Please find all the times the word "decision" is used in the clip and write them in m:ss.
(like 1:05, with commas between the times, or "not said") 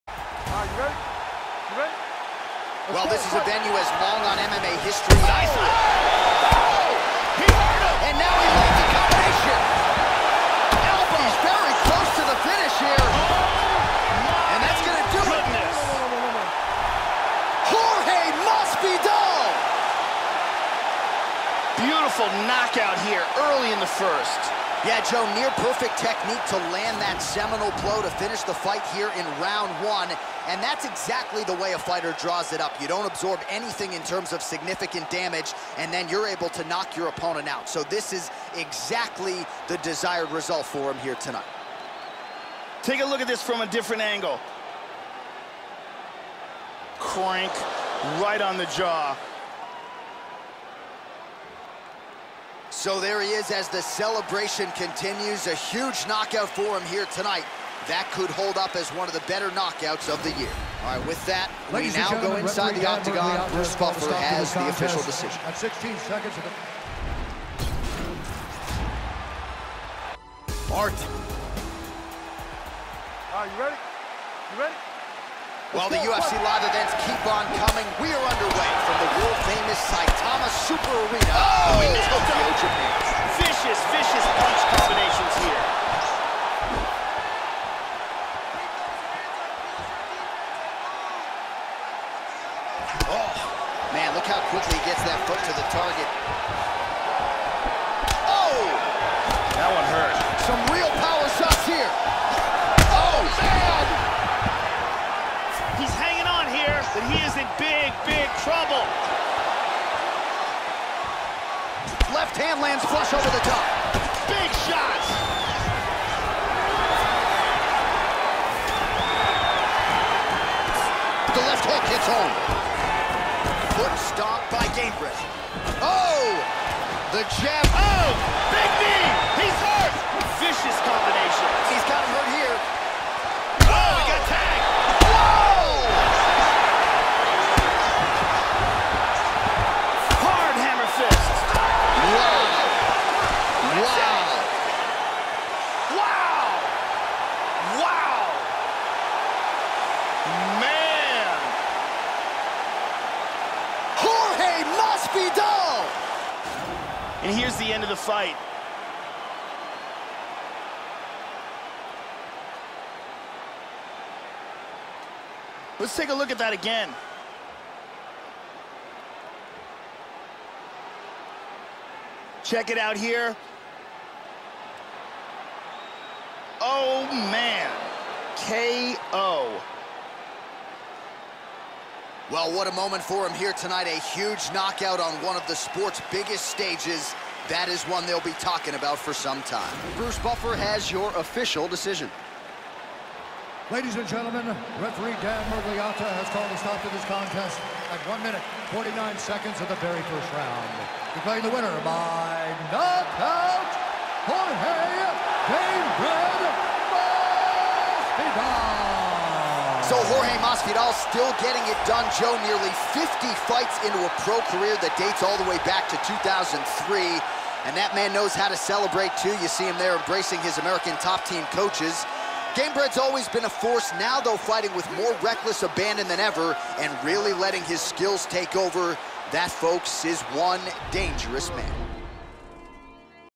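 1:05, 3:11.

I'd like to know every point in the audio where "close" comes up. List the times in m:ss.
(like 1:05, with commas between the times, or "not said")
0:11.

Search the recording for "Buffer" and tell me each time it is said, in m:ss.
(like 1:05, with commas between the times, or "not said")
1:03, 3:10.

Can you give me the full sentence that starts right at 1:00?
All right, with that, Ladies we now go inside the octagon.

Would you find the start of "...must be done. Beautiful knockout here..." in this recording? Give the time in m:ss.
0:18.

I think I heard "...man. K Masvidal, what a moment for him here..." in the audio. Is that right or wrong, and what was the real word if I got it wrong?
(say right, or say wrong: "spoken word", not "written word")
wrong: "Well", not "Masvidal".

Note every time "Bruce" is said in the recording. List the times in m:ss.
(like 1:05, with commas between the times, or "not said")
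1:03, 3:09.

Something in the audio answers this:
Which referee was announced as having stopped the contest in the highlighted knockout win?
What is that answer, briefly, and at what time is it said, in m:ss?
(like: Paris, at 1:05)
Dan Miragliotta, at 3:15.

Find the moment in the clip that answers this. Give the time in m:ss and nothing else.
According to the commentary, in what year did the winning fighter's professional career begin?
3:36.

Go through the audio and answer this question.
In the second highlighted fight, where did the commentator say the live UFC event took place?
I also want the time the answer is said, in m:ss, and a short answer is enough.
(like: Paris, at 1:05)
Saitama, at 1:19.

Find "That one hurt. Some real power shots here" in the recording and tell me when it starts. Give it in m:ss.
1:39.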